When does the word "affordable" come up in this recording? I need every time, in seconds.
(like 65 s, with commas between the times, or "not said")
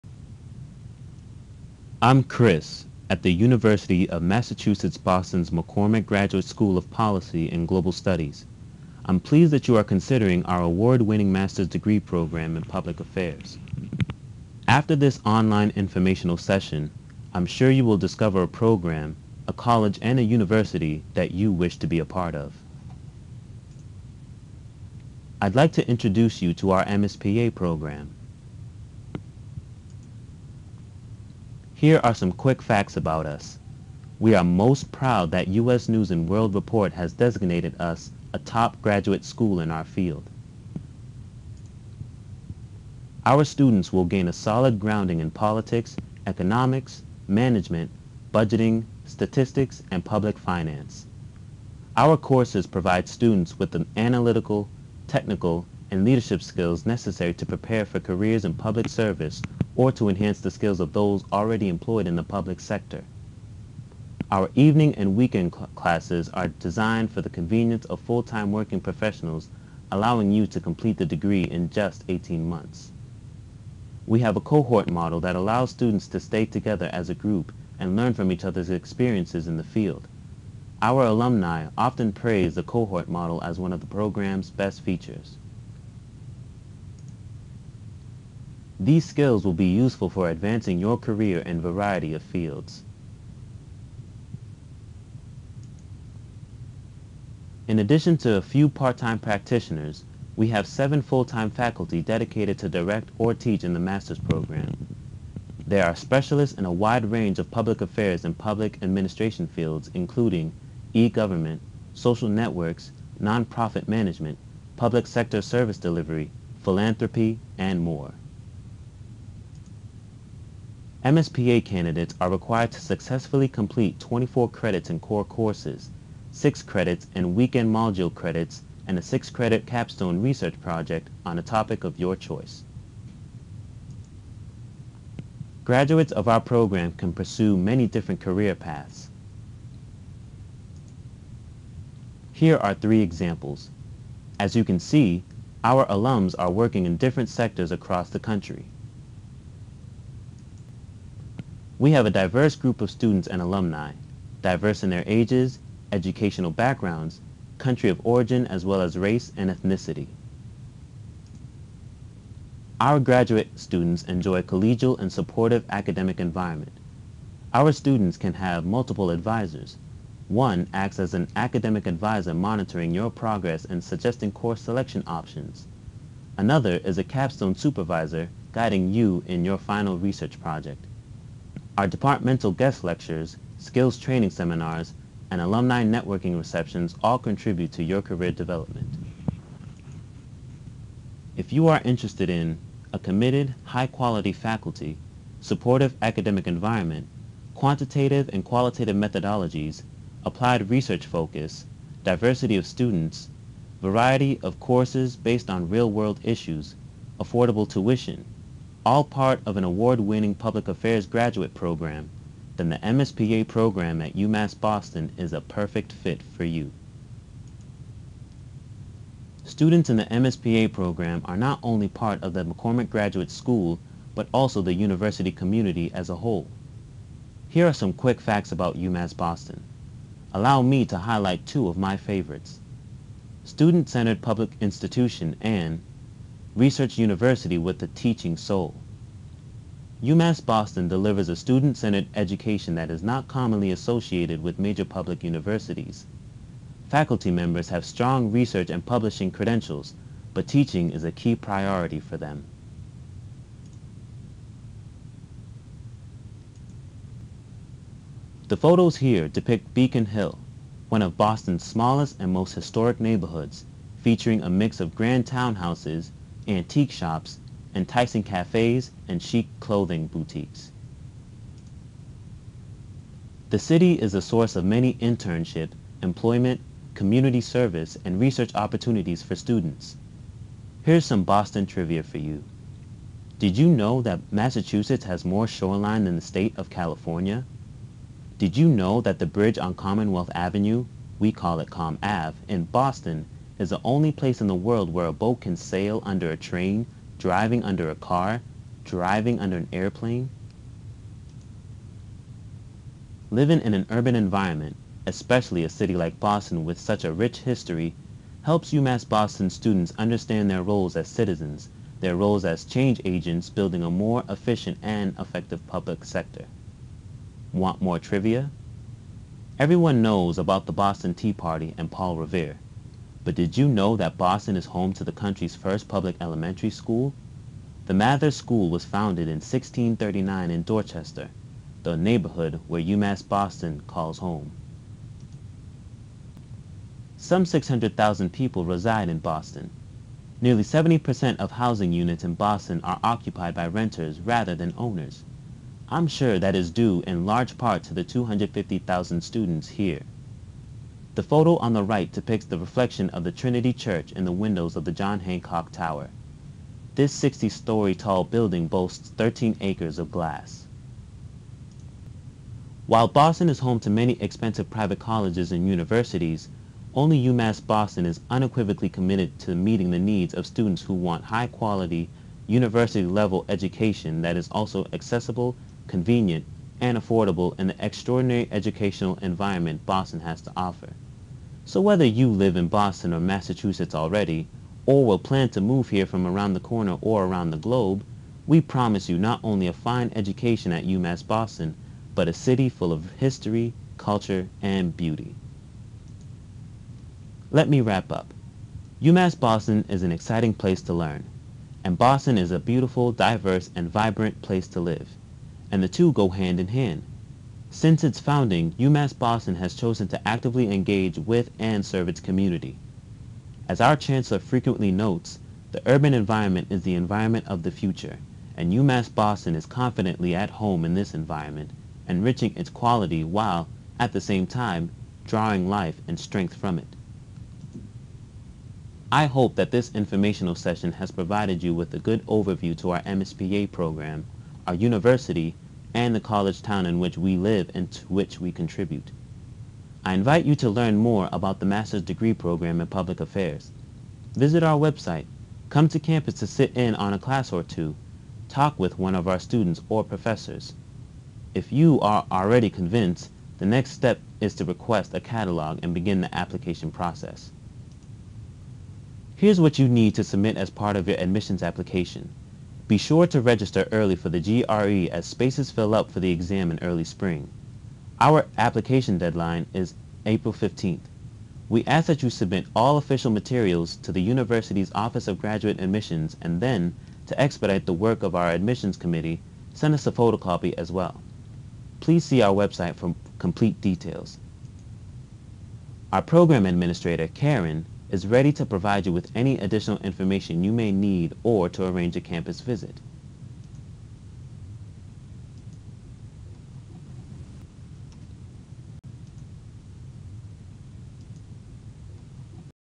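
207 s, 376 s.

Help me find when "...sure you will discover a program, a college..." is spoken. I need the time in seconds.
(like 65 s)
17 s.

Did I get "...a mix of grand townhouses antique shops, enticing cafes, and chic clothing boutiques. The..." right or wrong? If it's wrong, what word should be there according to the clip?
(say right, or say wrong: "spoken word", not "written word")
right.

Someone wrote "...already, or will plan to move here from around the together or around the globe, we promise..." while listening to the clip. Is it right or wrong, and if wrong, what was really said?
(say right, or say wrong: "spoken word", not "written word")
wrong: "corner", not "together".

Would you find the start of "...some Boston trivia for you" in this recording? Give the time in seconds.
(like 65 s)
281 s.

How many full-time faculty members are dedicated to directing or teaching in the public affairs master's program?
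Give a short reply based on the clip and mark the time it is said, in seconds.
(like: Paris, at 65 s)
7, at 100 s.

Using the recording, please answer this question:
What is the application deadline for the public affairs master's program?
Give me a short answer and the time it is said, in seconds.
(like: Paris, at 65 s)
April 15th, at 470 s.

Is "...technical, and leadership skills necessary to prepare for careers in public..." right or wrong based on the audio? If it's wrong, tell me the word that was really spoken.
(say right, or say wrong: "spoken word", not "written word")
right.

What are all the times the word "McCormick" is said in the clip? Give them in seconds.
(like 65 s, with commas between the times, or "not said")
5 s, 222 s.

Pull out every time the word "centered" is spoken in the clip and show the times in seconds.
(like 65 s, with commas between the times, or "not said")
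233 s, 241 s.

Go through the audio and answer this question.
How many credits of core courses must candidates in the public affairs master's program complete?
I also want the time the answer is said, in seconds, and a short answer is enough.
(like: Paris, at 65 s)
24, at 123 s.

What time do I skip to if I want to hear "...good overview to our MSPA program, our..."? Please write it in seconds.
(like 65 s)
431 s.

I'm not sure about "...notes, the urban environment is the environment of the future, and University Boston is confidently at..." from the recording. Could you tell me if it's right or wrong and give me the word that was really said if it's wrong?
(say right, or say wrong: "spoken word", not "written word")
wrong: "UMass", not "University".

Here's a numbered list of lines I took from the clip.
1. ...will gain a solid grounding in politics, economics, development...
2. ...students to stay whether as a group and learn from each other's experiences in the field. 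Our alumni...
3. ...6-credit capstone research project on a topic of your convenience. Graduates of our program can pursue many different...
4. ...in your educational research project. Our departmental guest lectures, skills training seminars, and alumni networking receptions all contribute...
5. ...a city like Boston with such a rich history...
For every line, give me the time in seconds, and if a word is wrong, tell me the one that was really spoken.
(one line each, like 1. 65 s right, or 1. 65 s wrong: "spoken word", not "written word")
1. 43 s wrong: "management", not "development"
2. 75 s wrong: "together", not "whether"
3. 129 s wrong: "choice", not "convenience"
4. 179 s wrong: "final", not "educational"
5. 305 s right.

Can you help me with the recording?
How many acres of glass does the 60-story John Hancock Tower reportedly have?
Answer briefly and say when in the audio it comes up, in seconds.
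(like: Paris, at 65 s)
13 acres, at 359 s.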